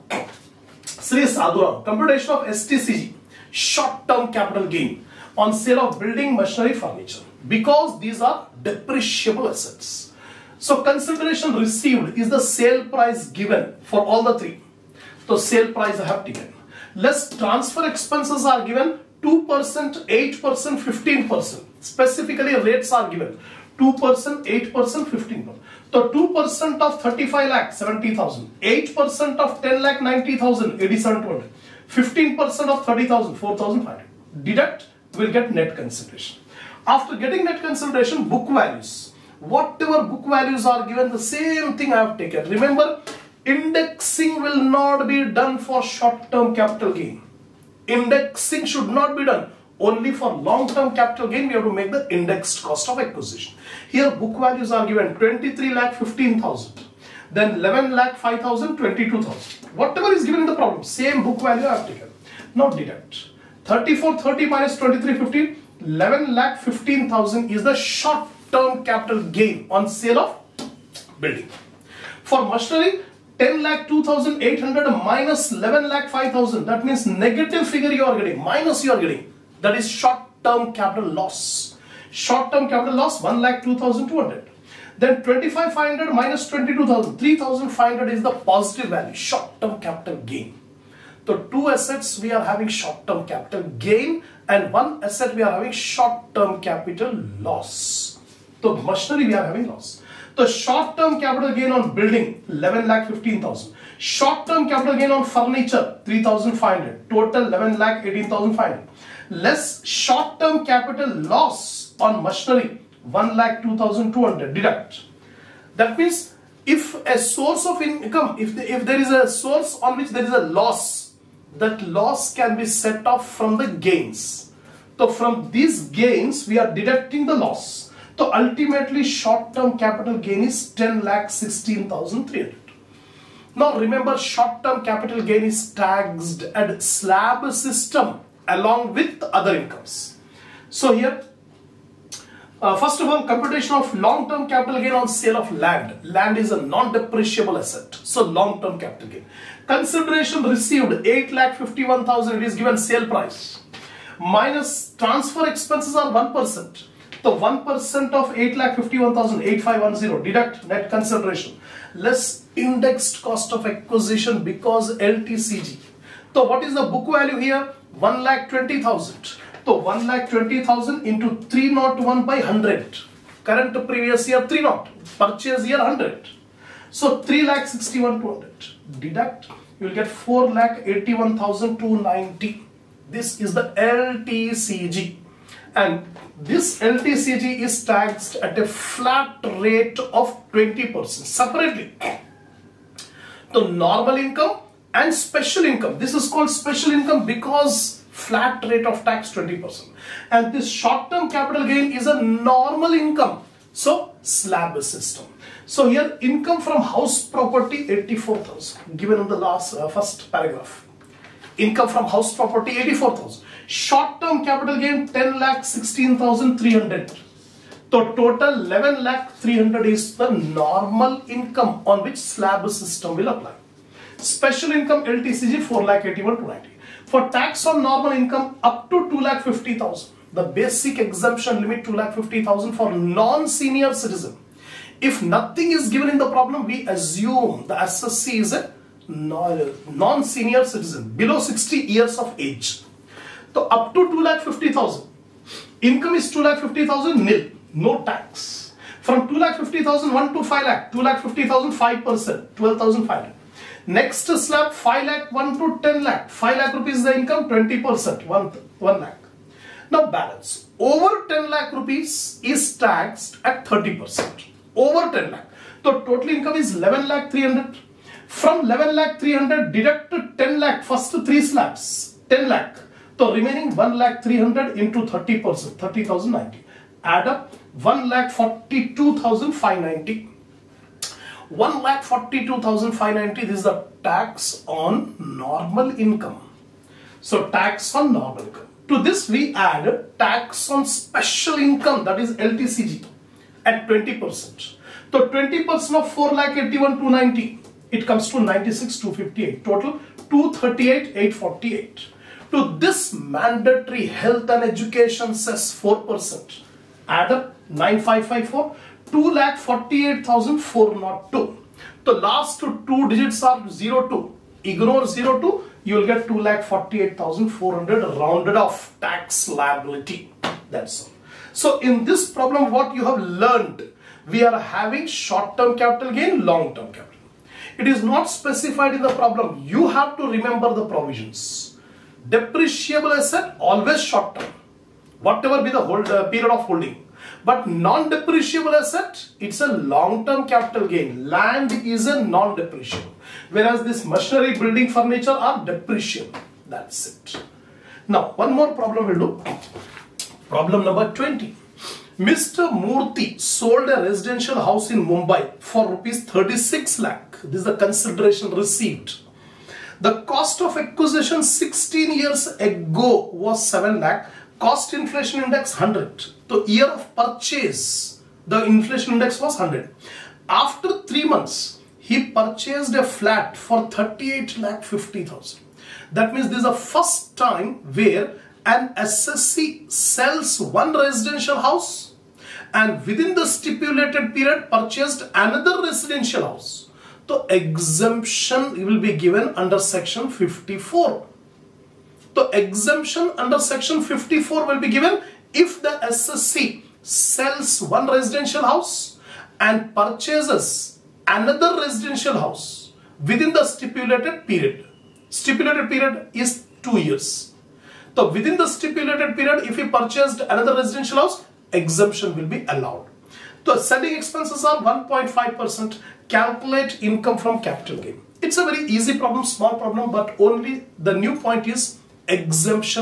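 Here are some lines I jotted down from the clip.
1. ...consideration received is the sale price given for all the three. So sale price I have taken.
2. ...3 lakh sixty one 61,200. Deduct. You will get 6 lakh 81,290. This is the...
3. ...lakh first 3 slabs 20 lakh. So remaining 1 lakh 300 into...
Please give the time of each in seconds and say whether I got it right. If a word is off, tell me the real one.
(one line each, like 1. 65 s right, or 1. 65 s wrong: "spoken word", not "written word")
1. 10 s right
2. 177 s wrong: "4", not "6"
3. 270 s wrong: "10", not "20".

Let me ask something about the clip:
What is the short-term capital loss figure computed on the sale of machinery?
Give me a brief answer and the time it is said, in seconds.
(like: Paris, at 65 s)
1 lakh 2,200, at 83 s.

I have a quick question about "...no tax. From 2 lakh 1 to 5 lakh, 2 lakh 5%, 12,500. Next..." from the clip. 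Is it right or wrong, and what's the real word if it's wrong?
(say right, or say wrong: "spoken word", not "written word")
right.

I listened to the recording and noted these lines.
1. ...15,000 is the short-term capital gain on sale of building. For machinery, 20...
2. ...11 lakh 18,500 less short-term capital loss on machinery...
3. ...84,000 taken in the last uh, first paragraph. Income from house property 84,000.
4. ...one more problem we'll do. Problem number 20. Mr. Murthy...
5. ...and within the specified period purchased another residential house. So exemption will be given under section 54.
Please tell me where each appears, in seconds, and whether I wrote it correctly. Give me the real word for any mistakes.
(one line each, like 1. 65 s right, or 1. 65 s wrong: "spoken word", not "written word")
1. 66 s wrong: "10", not "20"
2. 107 s right
3. 207 s wrong: "given", not "taken"
4. 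348 s right
5. 382 s wrong: "stipulated", not "specified".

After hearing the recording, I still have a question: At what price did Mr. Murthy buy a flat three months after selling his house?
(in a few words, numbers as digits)
38 lakh 50 thousand.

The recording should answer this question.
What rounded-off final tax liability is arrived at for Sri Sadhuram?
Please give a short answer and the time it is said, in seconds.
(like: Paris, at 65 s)
2,48,400, at 316 s.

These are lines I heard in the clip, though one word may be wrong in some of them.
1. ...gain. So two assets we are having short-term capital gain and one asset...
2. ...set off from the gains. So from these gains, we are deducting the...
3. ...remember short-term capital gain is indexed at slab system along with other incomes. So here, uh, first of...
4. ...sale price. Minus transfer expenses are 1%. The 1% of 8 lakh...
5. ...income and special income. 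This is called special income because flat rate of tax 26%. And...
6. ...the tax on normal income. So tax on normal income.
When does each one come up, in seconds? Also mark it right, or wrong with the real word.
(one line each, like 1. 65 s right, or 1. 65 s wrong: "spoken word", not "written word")
1. 90 s right
2. 122 s right
3. 133 s wrong: "taxed", not "indexed"
4. 152 s right
5. 194 s wrong: "20", not "26"
6. 283 s right.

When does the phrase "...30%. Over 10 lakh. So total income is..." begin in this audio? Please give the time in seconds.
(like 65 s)
263 s.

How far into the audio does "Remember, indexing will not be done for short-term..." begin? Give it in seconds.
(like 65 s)
42 s.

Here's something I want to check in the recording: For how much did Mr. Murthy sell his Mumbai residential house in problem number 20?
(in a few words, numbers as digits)
36 lakh.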